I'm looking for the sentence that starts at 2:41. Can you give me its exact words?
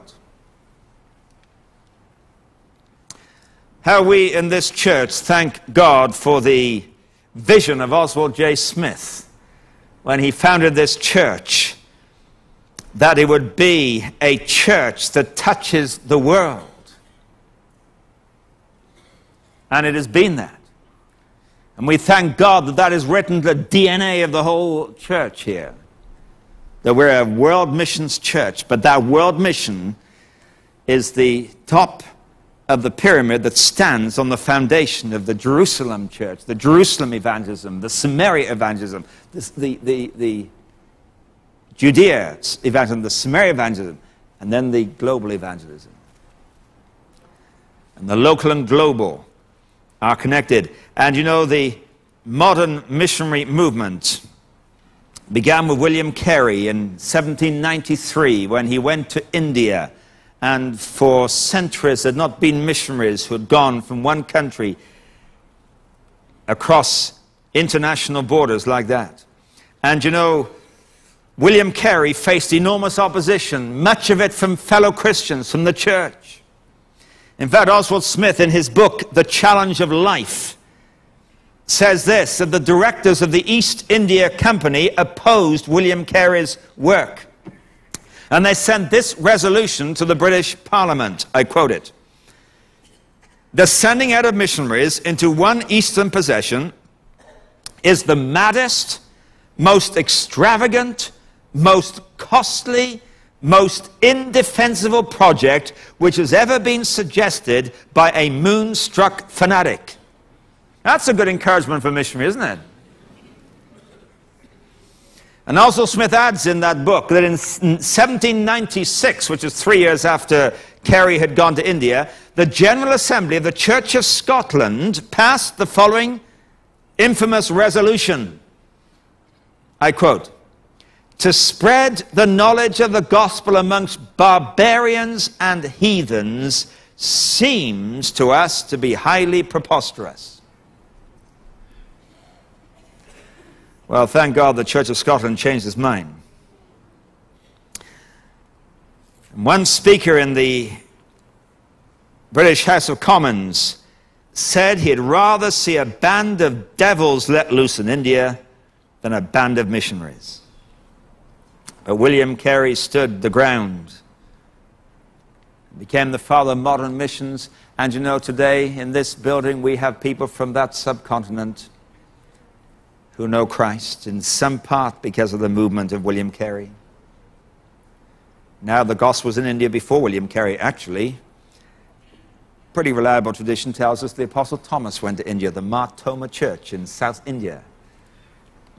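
But uh, William Carey stood the ground, became the father of modern missions.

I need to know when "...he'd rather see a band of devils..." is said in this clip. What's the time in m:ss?
2:34.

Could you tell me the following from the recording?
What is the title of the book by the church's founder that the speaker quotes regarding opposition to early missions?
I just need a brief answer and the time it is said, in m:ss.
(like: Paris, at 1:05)
The Challenge of Life, at 1:19.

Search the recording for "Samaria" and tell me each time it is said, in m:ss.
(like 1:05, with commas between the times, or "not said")
0:37, 0:43.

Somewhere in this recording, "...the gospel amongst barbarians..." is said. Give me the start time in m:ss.
2:12.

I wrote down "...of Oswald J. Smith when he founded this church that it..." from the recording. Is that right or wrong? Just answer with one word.
right.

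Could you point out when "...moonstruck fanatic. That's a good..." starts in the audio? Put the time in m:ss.
1:48.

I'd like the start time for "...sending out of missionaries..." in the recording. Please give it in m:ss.
1:33.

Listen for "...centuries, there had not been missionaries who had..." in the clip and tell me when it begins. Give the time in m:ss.
1:01.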